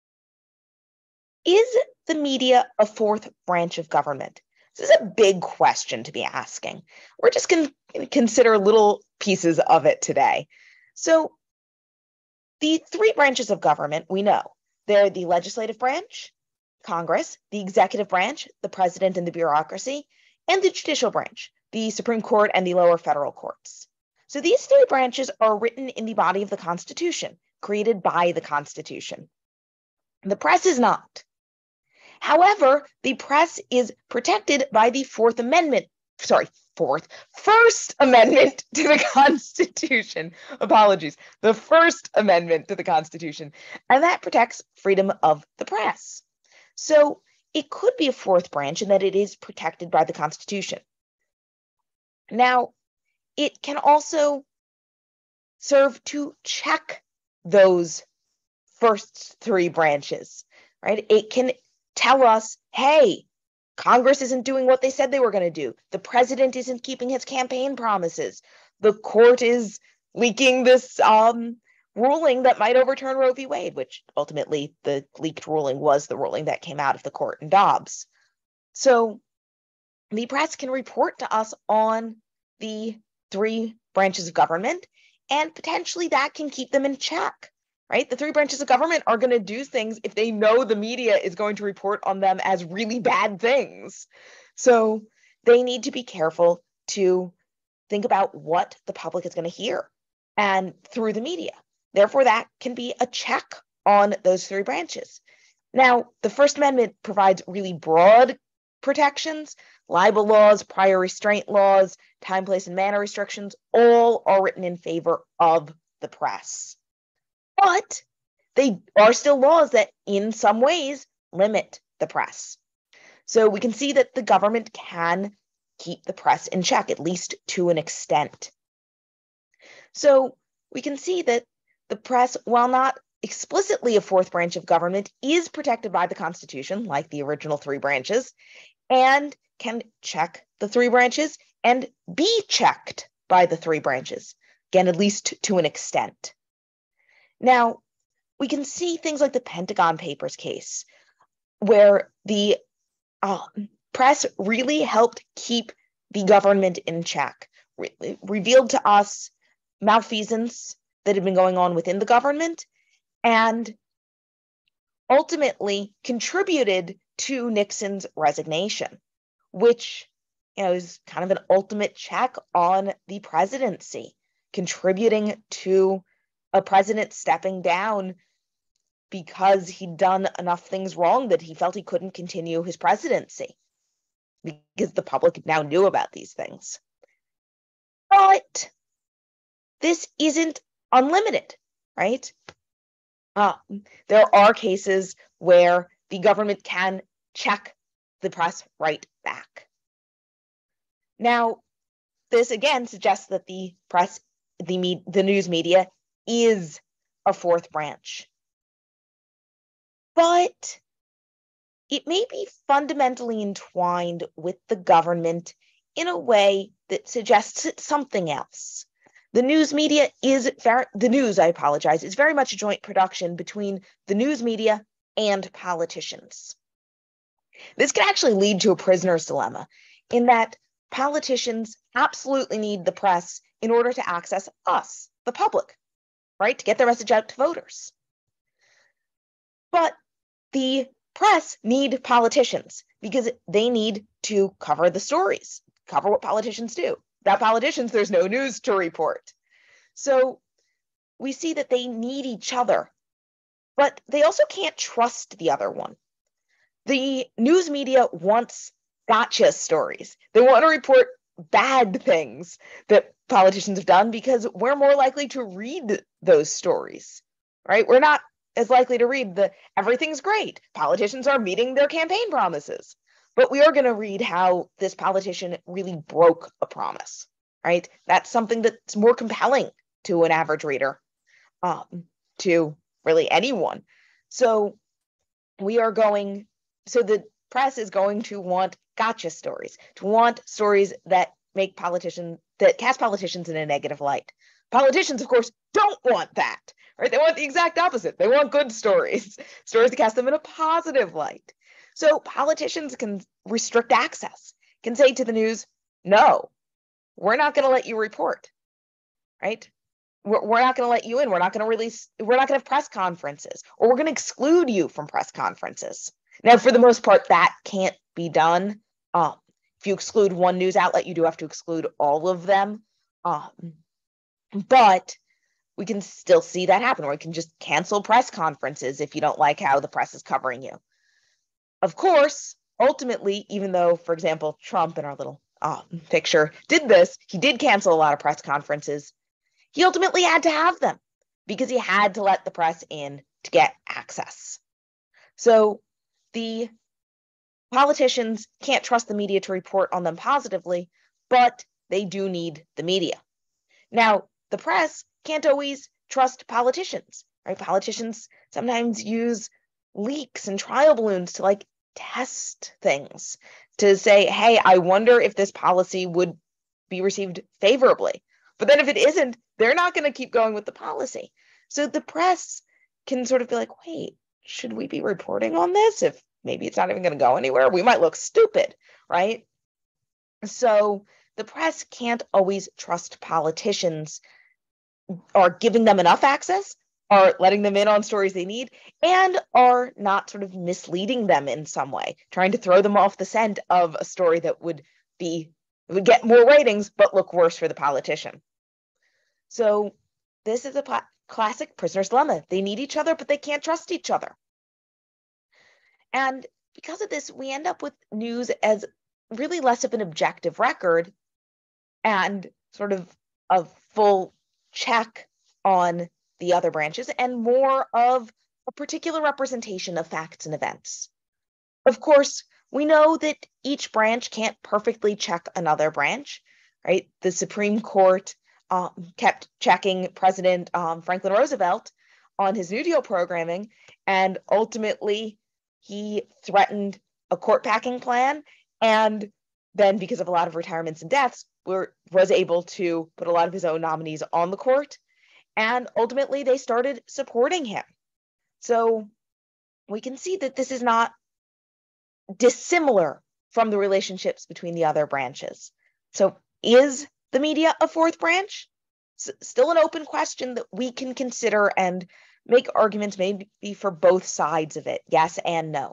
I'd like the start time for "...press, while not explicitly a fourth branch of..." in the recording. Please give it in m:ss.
2:11.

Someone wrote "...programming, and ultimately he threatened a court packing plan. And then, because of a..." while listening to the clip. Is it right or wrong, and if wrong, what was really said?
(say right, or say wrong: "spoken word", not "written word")
right.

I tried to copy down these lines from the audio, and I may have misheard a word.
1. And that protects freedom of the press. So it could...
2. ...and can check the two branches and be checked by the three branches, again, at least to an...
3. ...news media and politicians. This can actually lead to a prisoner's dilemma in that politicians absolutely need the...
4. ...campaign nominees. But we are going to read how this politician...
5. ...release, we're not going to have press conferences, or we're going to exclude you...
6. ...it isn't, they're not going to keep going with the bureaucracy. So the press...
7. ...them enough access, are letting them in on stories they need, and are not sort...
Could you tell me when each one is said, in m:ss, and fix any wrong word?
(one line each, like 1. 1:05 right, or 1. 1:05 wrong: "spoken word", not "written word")
1. 0:43 right
2. 2:18 wrong: "three", not "two"
3. 3:44 right
4. 4:31 wrong: "promises", not "nominees"
5. 5:11 right
6. 6:08 wrong: "policy", not "bureaucracy"
7. 6:25 right.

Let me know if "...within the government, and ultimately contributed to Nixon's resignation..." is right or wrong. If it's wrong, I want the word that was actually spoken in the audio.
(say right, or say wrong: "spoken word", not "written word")
right.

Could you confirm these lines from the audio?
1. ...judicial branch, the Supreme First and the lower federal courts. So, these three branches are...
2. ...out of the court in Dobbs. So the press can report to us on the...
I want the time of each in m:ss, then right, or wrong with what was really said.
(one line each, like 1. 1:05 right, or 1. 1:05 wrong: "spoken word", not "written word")
1. 0:20 wrong: "Court", not "First"
2. 1:16 right.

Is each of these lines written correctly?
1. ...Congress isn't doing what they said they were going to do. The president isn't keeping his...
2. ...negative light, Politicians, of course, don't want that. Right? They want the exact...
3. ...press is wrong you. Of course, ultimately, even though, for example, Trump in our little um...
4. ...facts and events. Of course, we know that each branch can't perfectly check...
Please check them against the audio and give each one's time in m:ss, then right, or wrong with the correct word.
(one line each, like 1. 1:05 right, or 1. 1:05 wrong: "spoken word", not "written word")
1. 1:03 right
2. 4:53 right
3. 5:29 wrong: "covering", not "wrong"
4. 7:00 right.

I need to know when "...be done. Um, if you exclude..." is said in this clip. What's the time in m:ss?
5:18.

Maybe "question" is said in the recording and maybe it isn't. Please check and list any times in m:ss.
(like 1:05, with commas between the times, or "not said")
0:05, 7:40.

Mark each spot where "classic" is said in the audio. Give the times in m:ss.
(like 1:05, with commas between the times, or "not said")
6:41.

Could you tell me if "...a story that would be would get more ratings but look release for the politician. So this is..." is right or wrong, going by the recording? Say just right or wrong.
wrong.